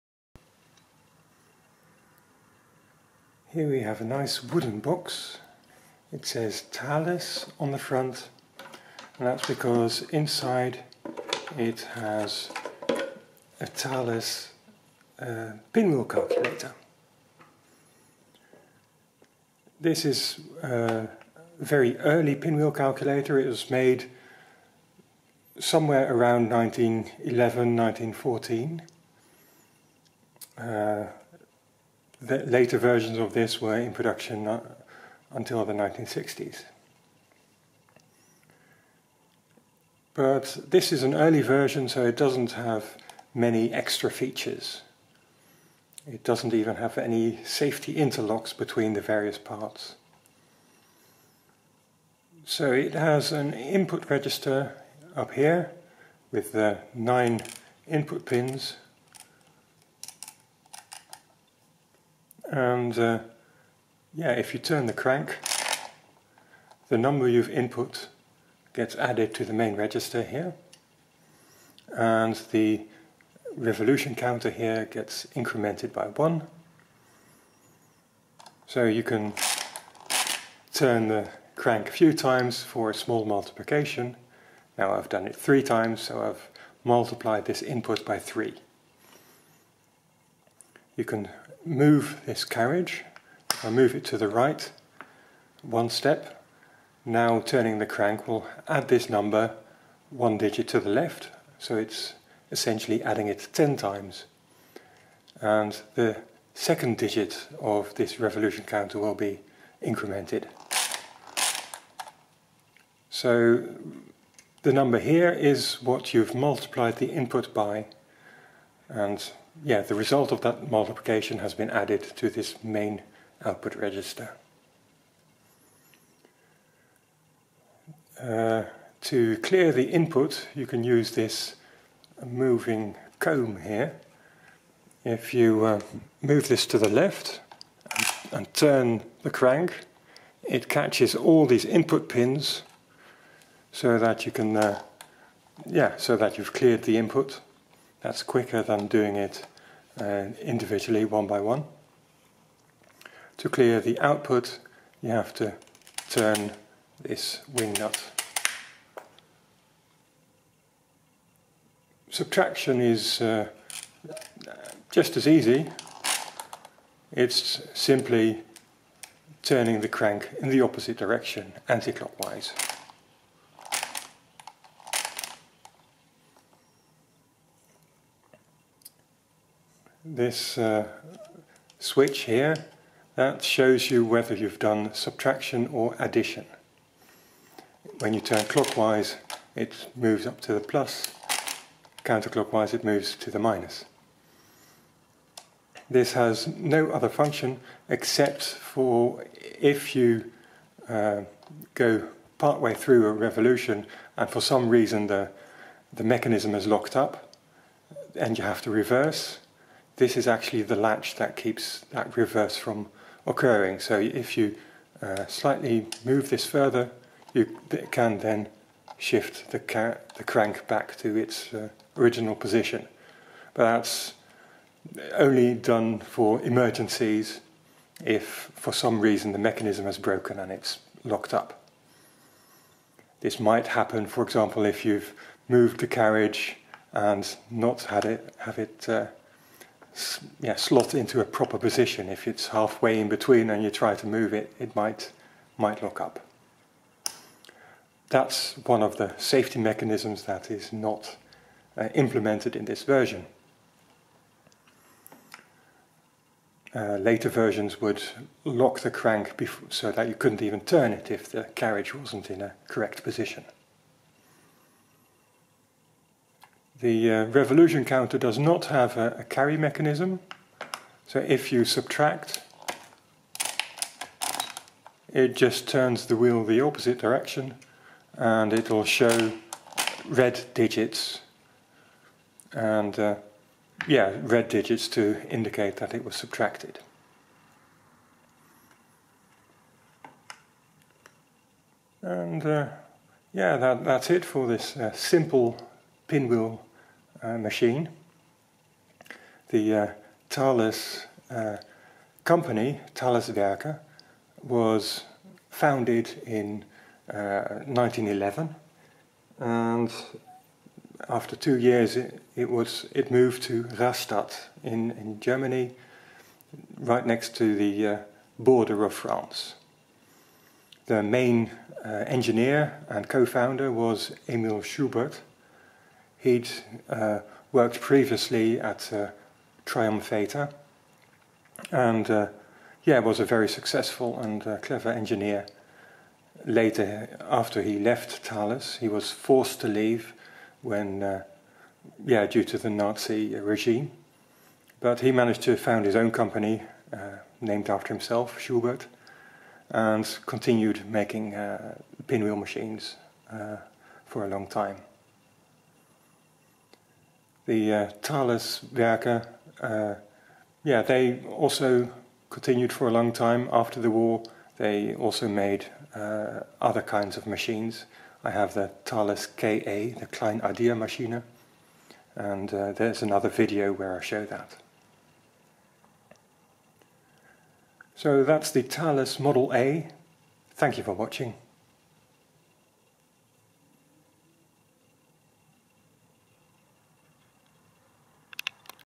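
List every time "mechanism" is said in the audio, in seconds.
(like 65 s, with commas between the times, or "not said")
206 s, 229 s, 249 s, 269 s.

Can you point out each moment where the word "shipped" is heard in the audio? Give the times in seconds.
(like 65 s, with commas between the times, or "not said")
not said.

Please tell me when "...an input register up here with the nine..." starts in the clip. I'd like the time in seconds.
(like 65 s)
53 s.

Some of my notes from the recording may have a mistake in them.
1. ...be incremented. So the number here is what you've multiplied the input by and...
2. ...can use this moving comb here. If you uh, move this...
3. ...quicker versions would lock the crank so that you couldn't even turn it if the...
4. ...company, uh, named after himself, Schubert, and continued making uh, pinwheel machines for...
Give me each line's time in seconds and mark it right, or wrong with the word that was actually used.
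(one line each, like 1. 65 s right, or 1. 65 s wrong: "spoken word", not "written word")
1. 109 s right
2. 130 s right
3. 256 s wrong: "later", not "quicker"
4. 346 s right.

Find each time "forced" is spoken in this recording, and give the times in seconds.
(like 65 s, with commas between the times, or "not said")
339 s.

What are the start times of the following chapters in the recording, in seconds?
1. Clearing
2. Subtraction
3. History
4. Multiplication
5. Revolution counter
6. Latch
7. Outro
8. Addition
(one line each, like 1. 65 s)
1. 127 s
2. 160 s
3. 298 s
4. 78 s
5. 264 s
6. 178 s
7. 375 s
8. 50 s.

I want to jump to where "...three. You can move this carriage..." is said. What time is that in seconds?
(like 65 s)
88 s.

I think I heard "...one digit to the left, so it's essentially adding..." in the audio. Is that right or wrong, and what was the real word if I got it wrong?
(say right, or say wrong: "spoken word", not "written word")
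right.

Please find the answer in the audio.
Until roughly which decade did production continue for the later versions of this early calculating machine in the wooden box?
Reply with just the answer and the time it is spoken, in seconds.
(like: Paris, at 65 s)
1960s, at 35 s.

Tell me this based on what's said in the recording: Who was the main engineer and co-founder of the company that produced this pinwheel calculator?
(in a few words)
Emil Schubert.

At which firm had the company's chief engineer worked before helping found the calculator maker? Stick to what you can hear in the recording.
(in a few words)
Triumphator.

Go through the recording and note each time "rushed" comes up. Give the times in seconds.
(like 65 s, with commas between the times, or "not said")
not said.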